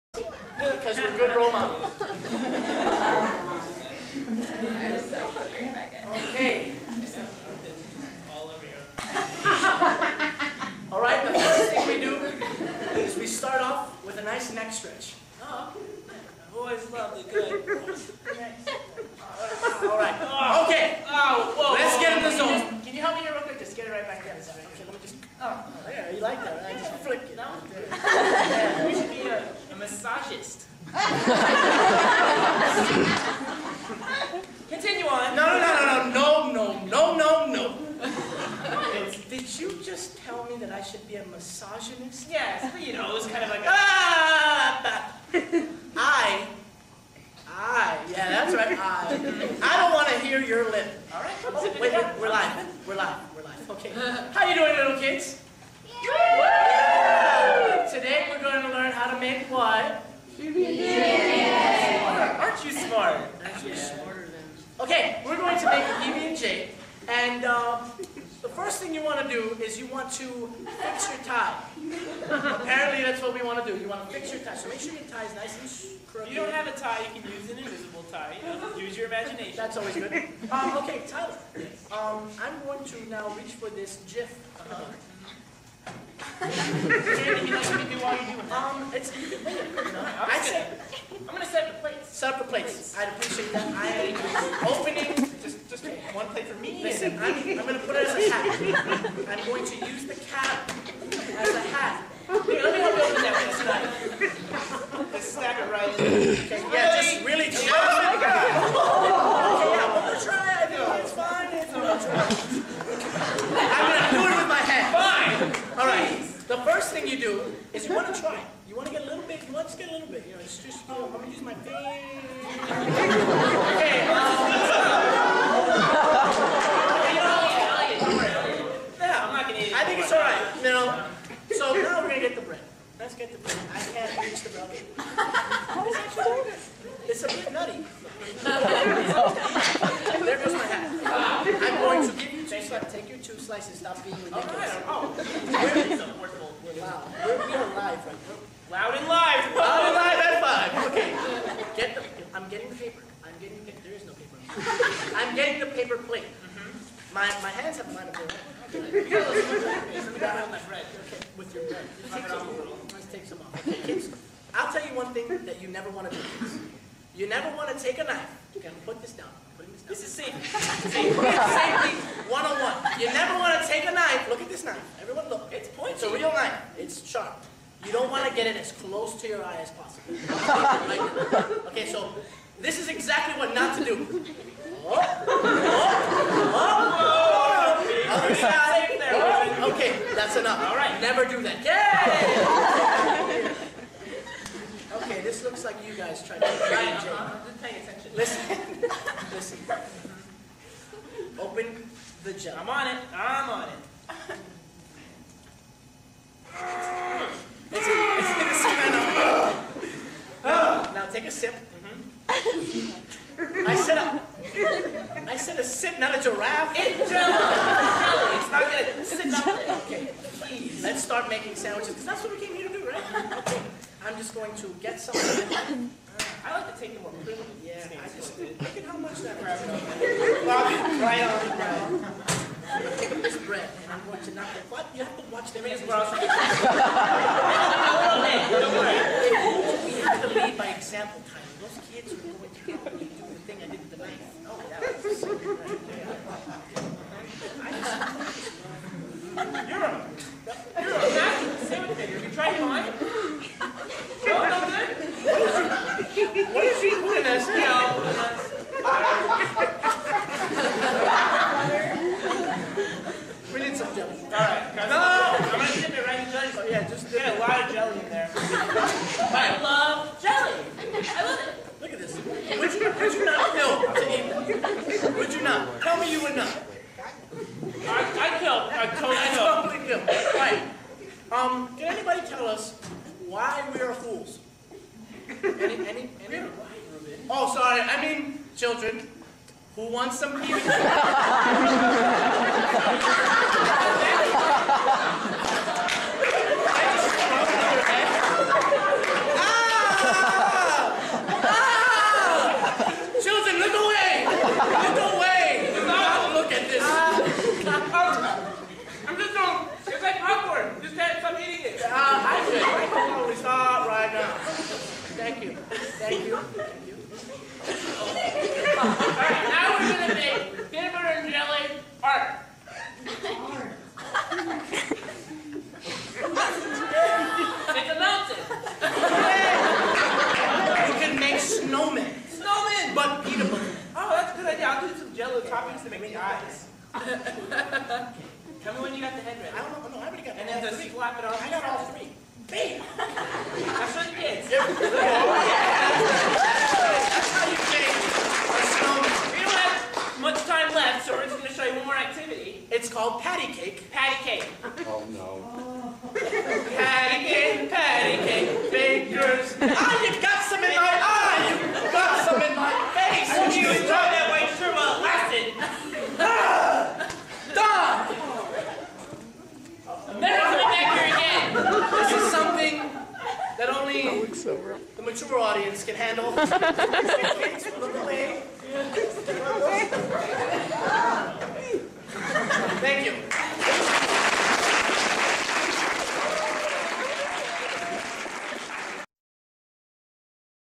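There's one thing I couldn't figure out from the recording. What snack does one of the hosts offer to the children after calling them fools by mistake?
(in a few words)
Peanuts.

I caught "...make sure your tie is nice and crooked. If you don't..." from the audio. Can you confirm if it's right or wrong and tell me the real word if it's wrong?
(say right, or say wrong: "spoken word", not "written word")
right.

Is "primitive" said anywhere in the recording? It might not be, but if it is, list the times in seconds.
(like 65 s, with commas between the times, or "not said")
227 s.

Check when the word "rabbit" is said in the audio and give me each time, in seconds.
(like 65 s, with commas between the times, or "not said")
229 s.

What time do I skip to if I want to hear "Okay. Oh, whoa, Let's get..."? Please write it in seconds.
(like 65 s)
20 s.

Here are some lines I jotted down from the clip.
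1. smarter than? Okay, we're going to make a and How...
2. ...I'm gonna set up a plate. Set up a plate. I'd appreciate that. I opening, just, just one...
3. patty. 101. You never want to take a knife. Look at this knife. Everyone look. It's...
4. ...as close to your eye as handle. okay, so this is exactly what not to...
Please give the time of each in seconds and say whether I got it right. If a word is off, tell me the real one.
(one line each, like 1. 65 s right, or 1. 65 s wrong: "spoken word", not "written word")
1. 63 s wrong: "Jake", not "How"
2. 91 s right
3. 170 s wrong: "safety", not "patty"
4. 178 s wrong: "possible", not "handle".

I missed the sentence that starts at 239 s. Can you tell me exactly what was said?
We have to lead by example, kind Those kids are going to do the thing I did with the knife.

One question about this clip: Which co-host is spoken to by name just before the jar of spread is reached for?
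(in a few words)
Tyler.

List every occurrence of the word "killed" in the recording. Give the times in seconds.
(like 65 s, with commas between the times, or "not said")
not said.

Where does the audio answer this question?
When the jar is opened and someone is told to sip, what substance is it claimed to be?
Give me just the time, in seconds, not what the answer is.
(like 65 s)
217 s.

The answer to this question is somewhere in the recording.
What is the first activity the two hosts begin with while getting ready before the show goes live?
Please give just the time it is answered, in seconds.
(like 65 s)
14 s.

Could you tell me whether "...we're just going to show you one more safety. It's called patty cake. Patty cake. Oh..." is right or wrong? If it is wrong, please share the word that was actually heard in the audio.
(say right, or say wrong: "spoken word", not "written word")
wrong: "activity", not "safety".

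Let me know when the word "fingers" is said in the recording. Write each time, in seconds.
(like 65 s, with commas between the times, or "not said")
121 s.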